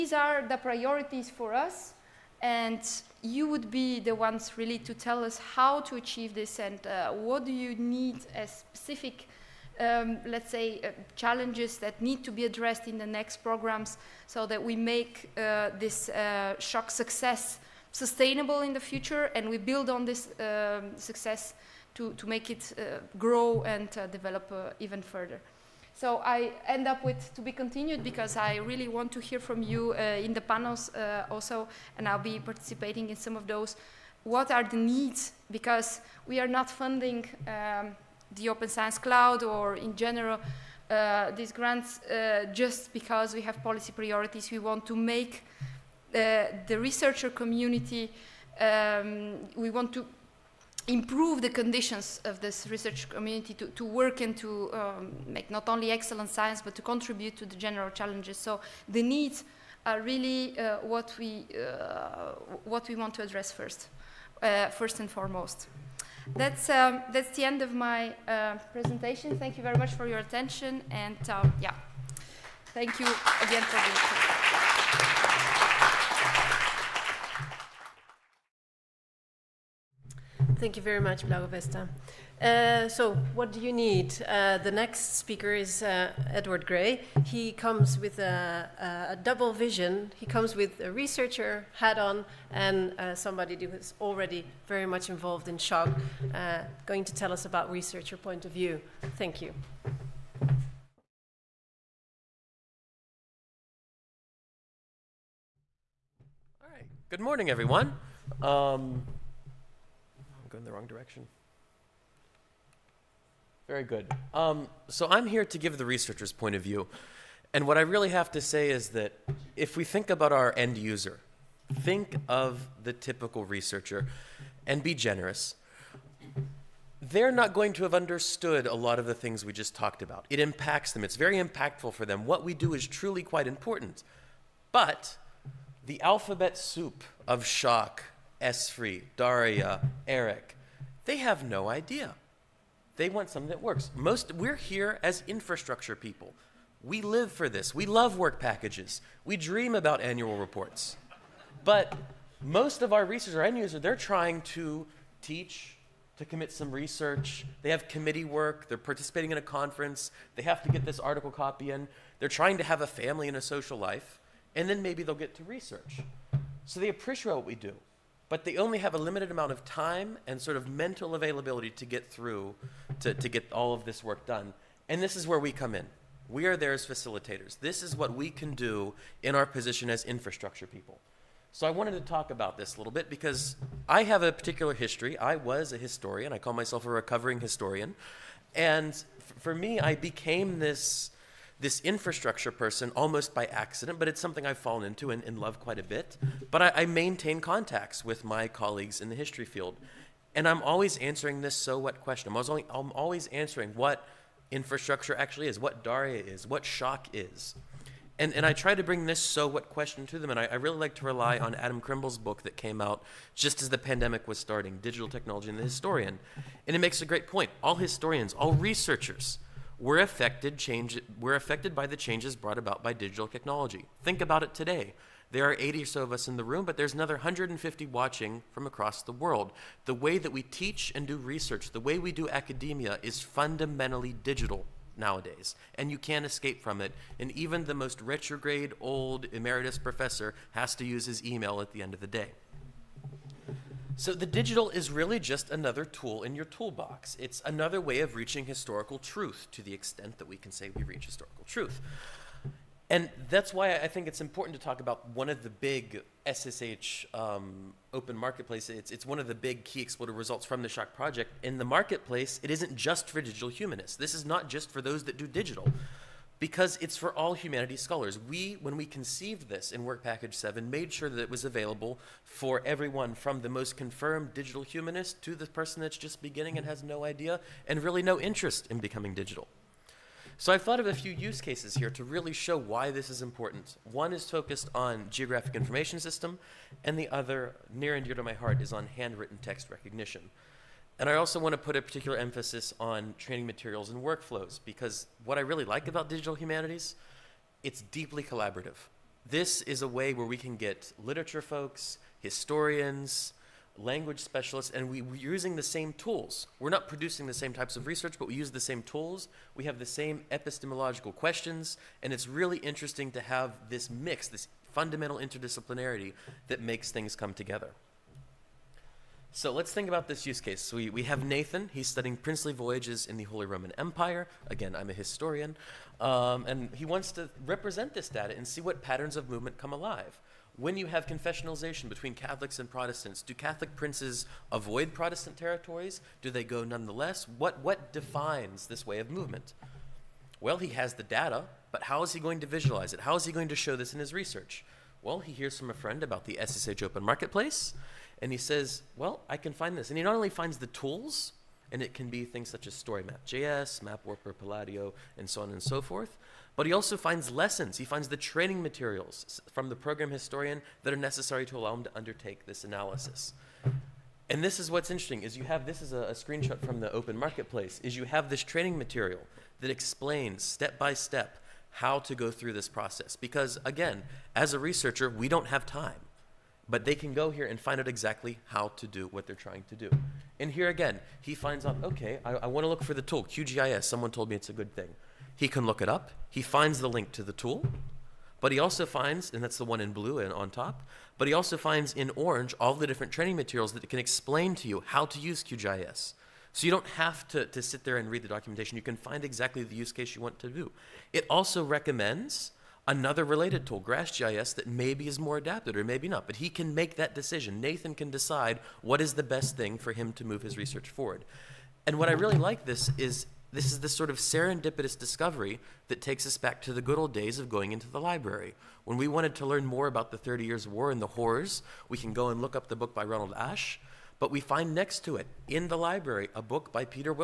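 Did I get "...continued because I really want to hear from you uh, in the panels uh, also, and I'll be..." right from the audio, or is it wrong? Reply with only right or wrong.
right.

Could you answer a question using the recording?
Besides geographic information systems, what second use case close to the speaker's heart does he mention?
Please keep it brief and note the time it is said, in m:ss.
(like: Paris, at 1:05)
handwritten text recognition, at 4:48.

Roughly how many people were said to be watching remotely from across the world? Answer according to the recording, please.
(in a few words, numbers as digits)
150.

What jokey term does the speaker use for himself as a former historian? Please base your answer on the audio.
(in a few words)
recovering historian.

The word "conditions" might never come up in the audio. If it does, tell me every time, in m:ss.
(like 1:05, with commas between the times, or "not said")
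0:51.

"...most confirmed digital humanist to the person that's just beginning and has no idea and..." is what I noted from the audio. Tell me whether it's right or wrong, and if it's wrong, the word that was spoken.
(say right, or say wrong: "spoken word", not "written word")
right.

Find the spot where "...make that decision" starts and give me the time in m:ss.
6:46.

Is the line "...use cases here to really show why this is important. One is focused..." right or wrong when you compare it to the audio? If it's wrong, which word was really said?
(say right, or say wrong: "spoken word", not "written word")
right.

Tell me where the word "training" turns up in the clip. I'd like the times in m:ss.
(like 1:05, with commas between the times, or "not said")
4:53, 5:58, 6:08, 6:33.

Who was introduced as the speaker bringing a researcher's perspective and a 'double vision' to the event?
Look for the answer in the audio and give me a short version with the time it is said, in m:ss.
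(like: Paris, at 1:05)
Edward Gray, at 1:26.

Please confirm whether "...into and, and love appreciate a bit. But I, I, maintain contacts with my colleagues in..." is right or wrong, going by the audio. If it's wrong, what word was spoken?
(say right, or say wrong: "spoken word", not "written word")
wrong: "quite", not "appreciate".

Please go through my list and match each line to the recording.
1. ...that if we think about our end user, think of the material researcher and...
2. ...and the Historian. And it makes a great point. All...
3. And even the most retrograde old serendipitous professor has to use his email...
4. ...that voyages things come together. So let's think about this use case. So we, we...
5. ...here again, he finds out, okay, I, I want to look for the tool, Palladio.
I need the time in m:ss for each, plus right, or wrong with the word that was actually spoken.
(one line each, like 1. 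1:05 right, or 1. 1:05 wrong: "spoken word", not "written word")
1. 1:58 wrong: "typical", not "material"
2. 3:35 right
3. 3:57 wrong: "emeritus", not "serendipitous"
4. 5:16 wrong: "makes", not "voyages"
5. 6:20 wrong: "QGIS", not "Palladio".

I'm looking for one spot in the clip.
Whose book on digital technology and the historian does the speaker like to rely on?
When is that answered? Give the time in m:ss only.
3:31.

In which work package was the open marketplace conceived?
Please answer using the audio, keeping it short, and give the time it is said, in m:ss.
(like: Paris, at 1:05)
Work Package 7, at 4:29.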